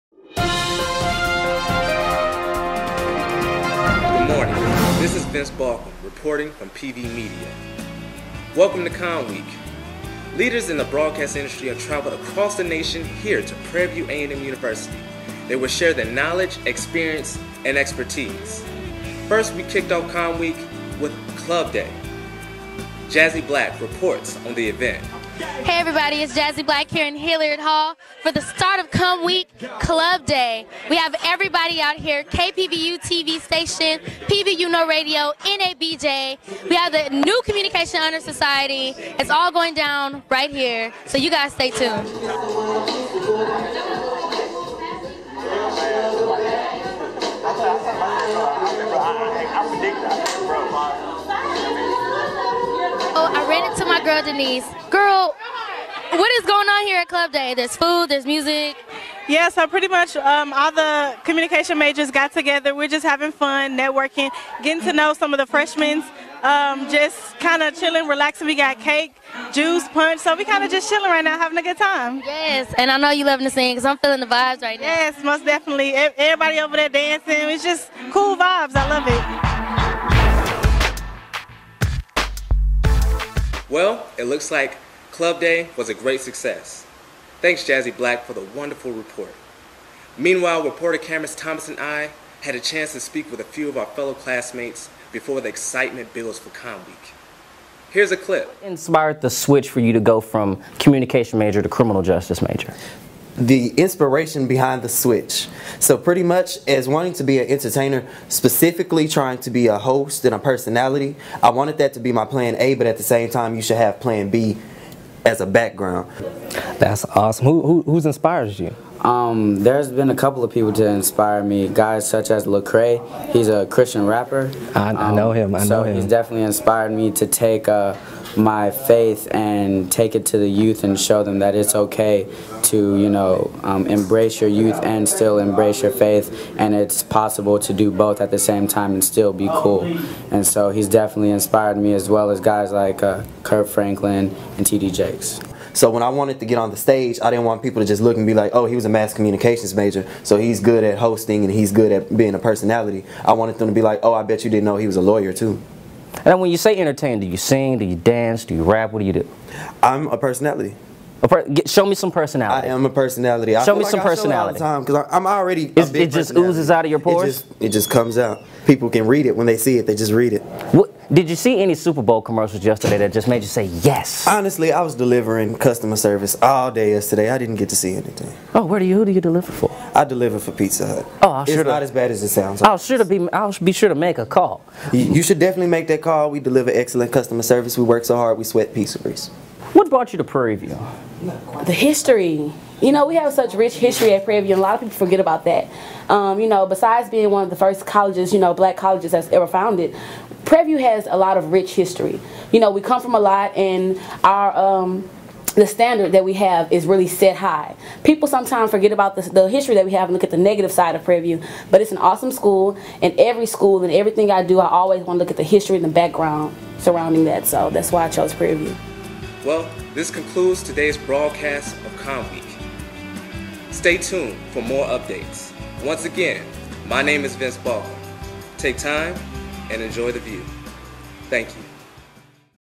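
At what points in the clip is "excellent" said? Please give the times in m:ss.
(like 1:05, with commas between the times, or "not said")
3:06.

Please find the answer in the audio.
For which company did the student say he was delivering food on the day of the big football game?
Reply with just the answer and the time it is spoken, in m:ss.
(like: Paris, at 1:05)
Pizza Hut, at 3:00.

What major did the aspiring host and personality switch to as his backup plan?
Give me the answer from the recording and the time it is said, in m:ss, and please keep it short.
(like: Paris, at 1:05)
Criminal justice, at 1:41.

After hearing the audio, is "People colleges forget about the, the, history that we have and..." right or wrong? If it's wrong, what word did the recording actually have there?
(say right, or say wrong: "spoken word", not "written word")
wrong: "sometimes", not "colleges".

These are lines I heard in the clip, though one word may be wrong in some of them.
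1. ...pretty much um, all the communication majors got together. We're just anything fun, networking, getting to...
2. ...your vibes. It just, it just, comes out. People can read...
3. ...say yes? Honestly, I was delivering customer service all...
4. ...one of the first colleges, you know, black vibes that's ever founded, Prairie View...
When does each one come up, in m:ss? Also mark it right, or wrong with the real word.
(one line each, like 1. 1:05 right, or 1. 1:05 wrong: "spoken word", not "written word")
1. 0:59 wrong: "having", not "anything"
2. 2:46 wrong: "pores", not "vibes"
3. 2:53 right
4. 3:17 wrong: "colleges", not "vibes".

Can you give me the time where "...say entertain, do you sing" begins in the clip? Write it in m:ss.
2:36.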